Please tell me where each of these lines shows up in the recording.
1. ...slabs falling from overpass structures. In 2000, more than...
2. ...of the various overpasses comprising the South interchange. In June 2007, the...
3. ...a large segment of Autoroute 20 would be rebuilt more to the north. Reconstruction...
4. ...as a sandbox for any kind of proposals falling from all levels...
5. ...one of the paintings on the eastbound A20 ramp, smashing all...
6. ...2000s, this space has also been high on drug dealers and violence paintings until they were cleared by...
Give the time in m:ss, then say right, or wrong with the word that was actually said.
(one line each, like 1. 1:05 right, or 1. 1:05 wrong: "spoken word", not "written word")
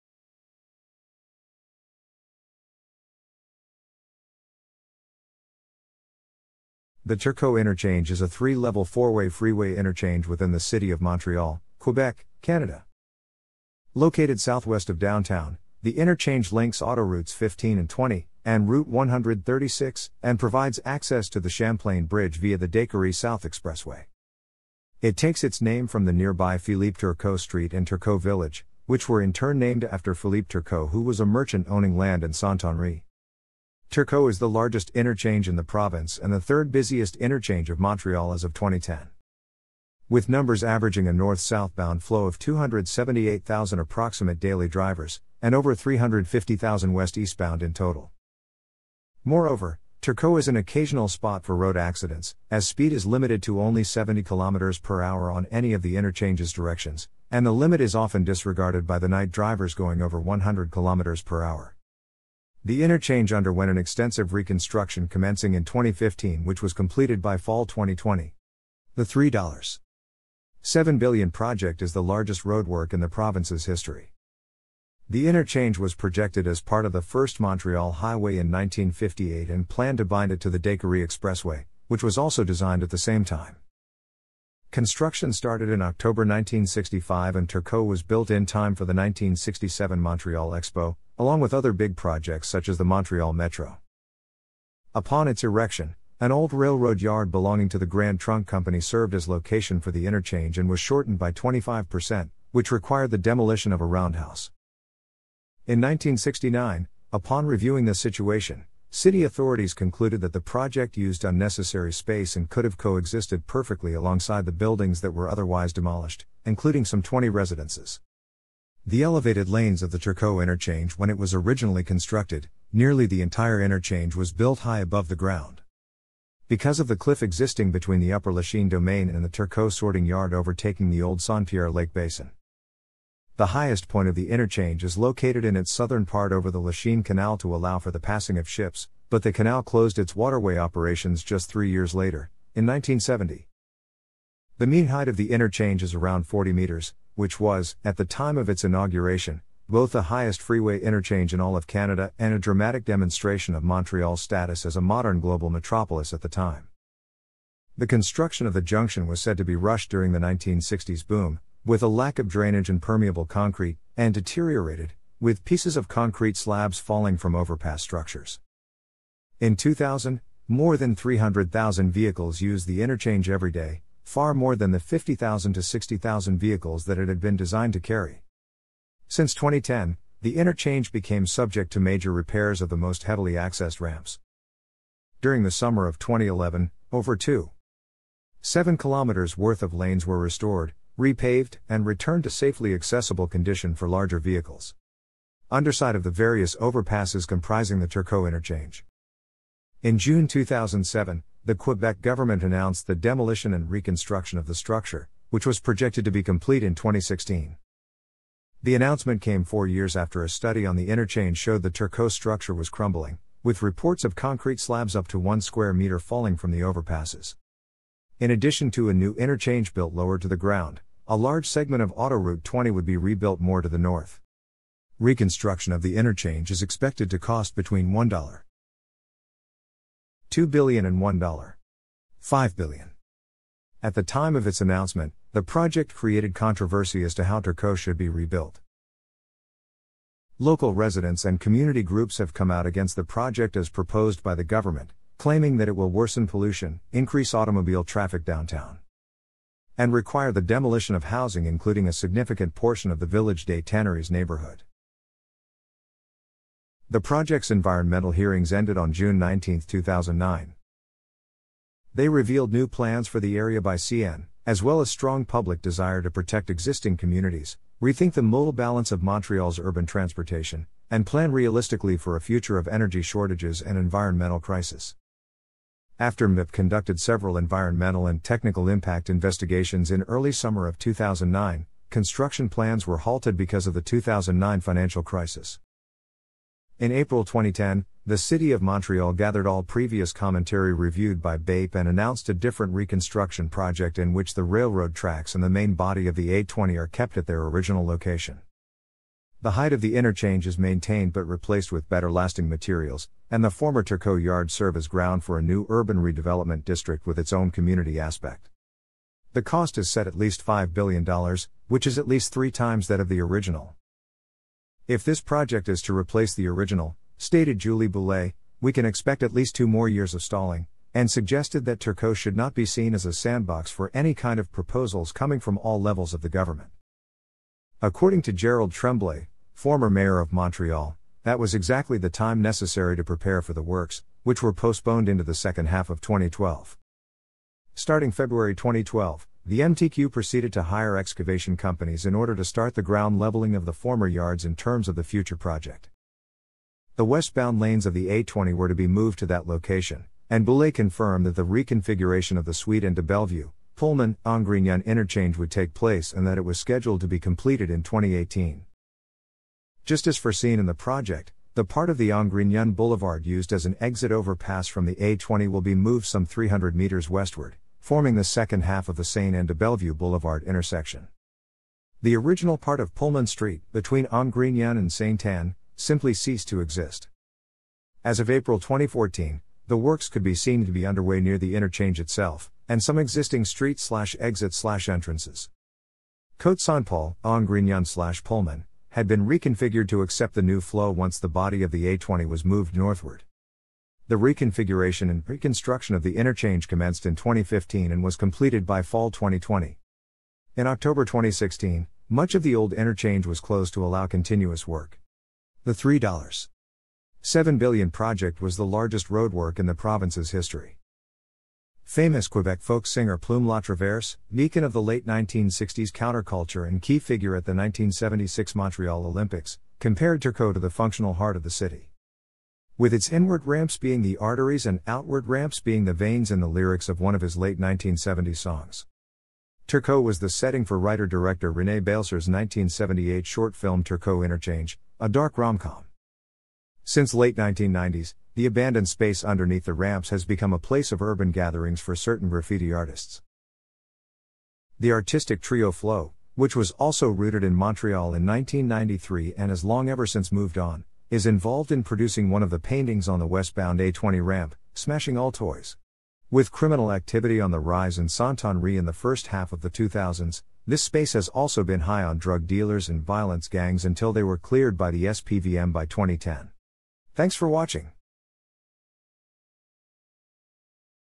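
1. 2:46 right
2. 3:15 wrong: "Turcot", not "South"
3. 3:41 right
4. 5:22 wrong: "coming", not "falling"
5. 7:32 wrong: "westbound", not "eastbound"
6. 7:39 wrong: "gangs", not "paintings".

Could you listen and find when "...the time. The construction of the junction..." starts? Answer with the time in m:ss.
2:36.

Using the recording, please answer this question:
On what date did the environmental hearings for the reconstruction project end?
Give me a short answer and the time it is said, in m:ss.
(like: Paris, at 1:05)
June 19, 2009, at 4:18.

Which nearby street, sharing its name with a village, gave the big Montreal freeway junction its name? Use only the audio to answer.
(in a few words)
Philippe Turcot Street.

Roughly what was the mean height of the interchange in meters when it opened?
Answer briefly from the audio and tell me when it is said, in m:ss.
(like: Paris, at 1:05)
40, at 2:26.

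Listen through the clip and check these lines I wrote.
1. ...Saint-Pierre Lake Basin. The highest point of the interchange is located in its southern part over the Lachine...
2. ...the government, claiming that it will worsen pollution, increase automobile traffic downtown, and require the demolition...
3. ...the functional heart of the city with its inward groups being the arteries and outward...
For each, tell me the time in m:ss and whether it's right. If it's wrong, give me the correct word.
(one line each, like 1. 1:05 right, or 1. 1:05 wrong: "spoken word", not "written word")
1. 2:11 right
2. 4:04 right
3. 7:00 wrong: "ramps", not "groups".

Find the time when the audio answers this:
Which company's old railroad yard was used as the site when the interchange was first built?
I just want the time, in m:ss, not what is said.
1:37.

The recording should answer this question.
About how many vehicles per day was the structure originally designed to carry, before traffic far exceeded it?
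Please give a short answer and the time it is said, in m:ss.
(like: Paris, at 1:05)
50,000 to 60,000, at 2:54.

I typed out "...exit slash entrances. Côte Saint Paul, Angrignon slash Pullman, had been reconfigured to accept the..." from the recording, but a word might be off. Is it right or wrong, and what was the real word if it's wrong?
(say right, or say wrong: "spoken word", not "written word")
right.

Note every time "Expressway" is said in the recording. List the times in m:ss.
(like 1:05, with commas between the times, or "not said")
0:23, 1:21.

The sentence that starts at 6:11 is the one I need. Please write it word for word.
The original part of Pullman Street, between Angrignon and Saint Anne, simply ceased to exist.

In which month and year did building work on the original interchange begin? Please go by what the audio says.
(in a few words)
October 1965.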